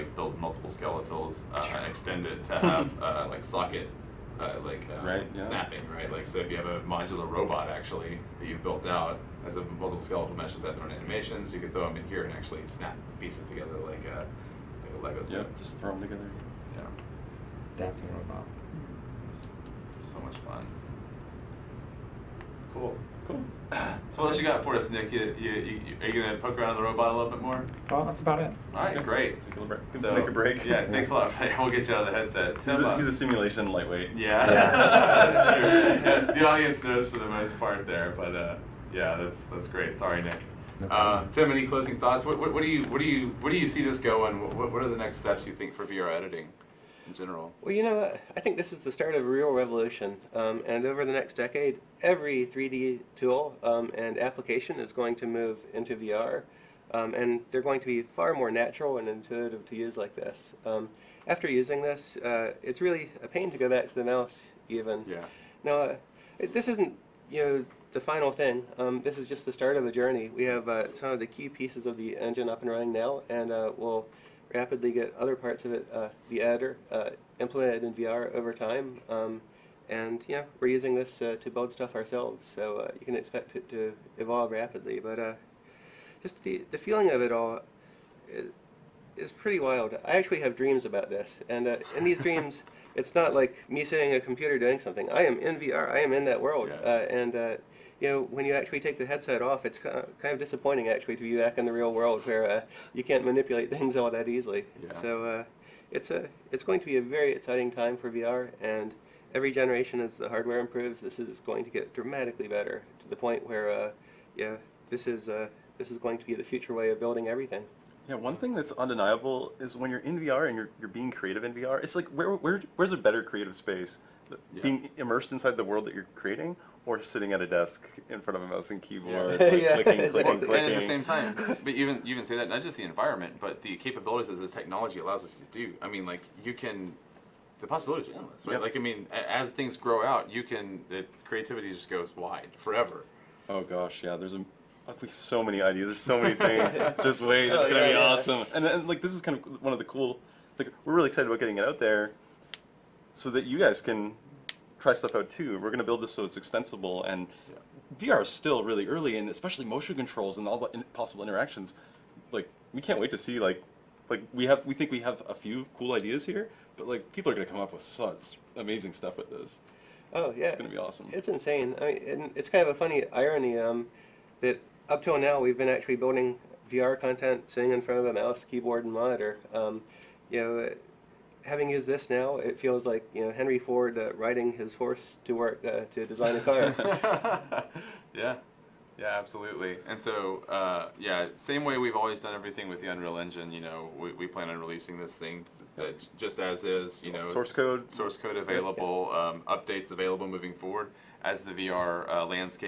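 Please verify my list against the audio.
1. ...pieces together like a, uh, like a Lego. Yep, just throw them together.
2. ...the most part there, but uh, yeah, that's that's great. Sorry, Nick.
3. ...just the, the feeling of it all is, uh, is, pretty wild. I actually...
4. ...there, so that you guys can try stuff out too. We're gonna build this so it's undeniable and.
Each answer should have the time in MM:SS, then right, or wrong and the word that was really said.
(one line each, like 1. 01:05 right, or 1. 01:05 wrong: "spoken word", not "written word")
1. 00:13 right
2. 00:37 right
3. 01:26 right
4. 02:31 wrong: "extensible", not "undeniable".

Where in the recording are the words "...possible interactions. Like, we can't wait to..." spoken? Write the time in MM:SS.
02:40.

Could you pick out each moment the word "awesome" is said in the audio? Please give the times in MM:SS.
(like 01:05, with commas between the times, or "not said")
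02:27, 02:50.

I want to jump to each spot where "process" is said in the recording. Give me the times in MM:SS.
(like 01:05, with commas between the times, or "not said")
not said.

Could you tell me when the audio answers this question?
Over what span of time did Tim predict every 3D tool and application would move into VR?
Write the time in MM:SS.
00:51.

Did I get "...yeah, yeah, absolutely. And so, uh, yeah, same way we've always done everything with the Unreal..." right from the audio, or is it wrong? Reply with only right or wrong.
right.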